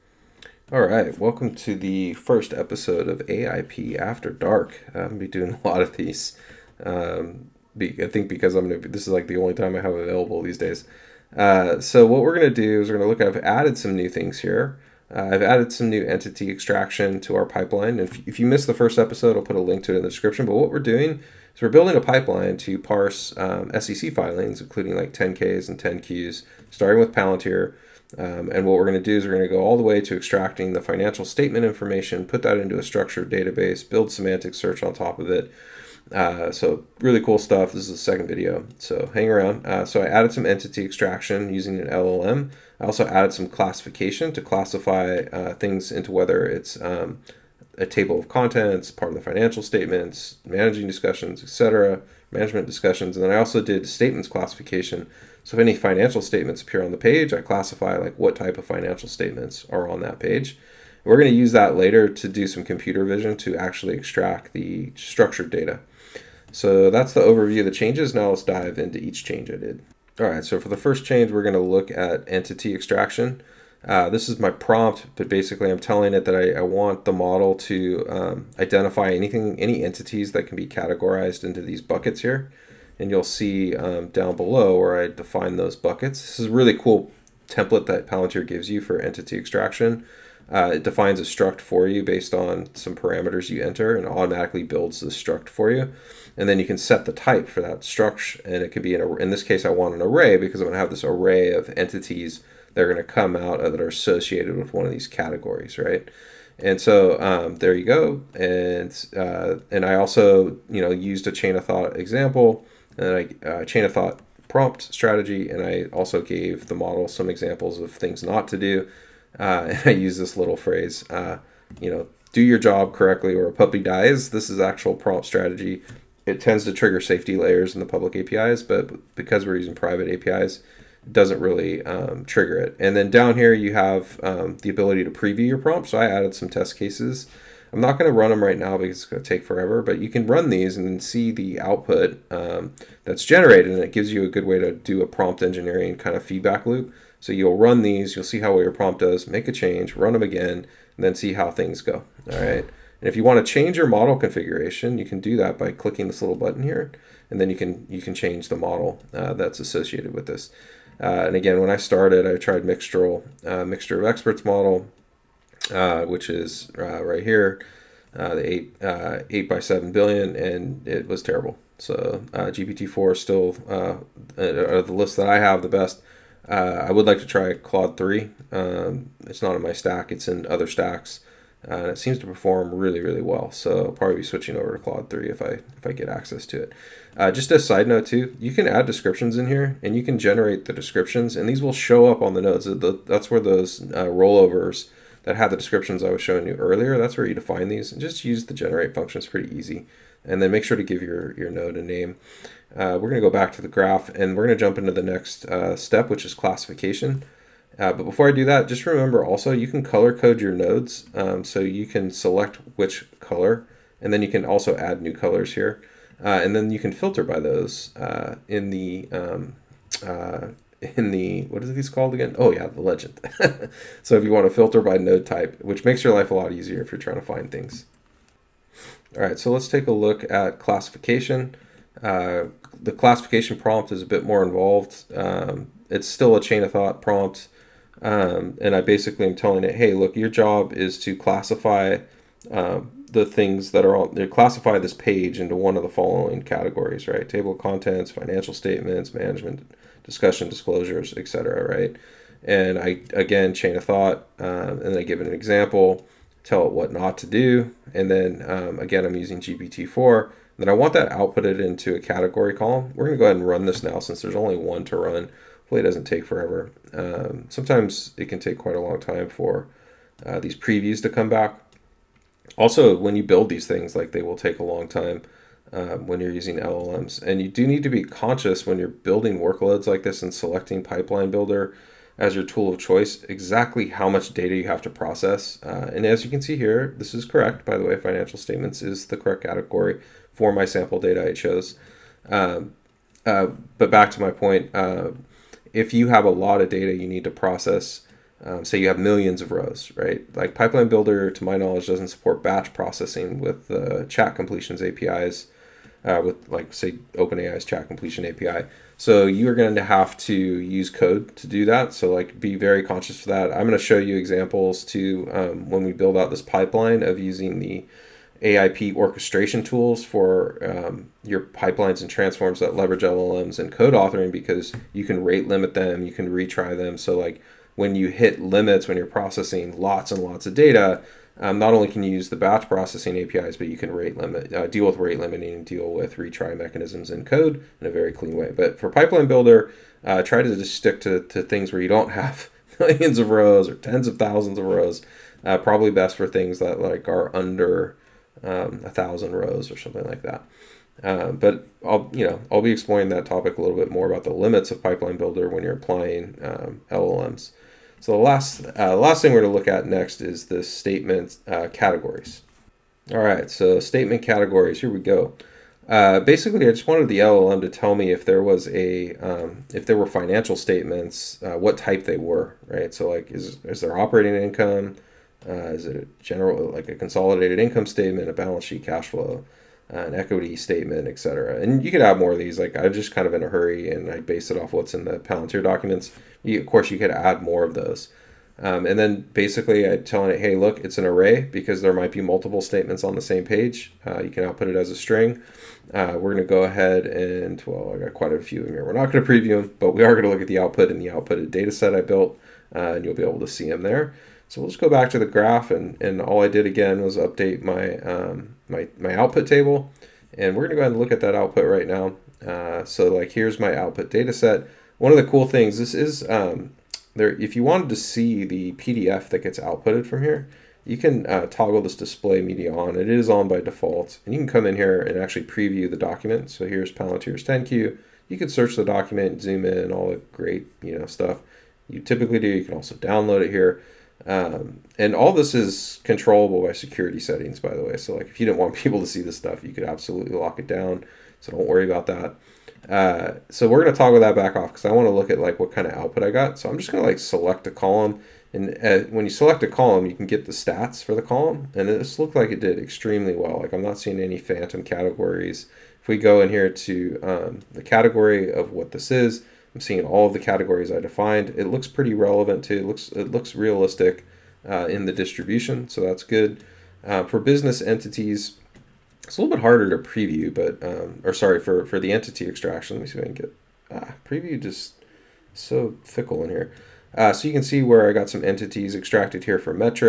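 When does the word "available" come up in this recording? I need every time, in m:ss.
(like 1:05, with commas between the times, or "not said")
0:09.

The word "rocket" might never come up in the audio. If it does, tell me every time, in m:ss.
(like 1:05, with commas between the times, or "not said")
not said.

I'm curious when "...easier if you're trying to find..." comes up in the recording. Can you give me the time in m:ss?
3:46.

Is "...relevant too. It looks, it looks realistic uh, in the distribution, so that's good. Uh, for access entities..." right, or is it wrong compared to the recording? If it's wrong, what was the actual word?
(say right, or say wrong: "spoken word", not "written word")
wrong: "business", not "access".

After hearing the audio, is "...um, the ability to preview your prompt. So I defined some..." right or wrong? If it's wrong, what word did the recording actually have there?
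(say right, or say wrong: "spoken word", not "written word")
wrong: "added", not "defined".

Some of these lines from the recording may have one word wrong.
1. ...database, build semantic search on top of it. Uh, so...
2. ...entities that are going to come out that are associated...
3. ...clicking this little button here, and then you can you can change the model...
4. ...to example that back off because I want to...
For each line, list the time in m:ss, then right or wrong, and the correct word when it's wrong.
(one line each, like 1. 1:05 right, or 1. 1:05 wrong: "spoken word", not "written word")
1. 0:33 right
2. 1:41 right
3. 2:35 right
4. 7:23 wrong: "toggle", not "example".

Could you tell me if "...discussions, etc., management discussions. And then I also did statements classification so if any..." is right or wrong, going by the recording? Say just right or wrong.
right.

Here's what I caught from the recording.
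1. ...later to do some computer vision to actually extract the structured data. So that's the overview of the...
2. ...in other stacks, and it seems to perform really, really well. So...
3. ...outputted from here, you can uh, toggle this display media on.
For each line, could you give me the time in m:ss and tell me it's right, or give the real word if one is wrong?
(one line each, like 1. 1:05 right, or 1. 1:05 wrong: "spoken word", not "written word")
1. 1:01 right
2. 3:00 right
3. 6:59 right.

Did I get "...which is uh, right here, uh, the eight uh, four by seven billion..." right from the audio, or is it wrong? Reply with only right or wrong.
wrong.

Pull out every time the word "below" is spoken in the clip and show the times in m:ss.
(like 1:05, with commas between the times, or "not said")
1:24.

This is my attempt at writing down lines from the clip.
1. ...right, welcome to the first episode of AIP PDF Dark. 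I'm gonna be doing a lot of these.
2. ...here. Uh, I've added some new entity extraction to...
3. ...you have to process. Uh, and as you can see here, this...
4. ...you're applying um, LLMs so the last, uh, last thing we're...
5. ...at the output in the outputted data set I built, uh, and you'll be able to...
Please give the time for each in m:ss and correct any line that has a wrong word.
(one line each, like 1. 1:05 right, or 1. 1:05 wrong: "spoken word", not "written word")
1. 0:00 wrong: "After", not "PDF"
2. 0:14 right
3. 4:44 right
4. 5:55 right
5. 6:40 right.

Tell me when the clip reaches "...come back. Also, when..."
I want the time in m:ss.
4:31.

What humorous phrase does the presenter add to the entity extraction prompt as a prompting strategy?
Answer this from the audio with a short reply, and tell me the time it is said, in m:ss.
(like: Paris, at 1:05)
Do your job correctly or a puppy dies, at 2:02.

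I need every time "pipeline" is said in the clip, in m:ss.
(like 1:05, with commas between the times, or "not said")
0:17, 0:22, 4:40, 5:00, 5:16, 5:21, 5:38, 5:54.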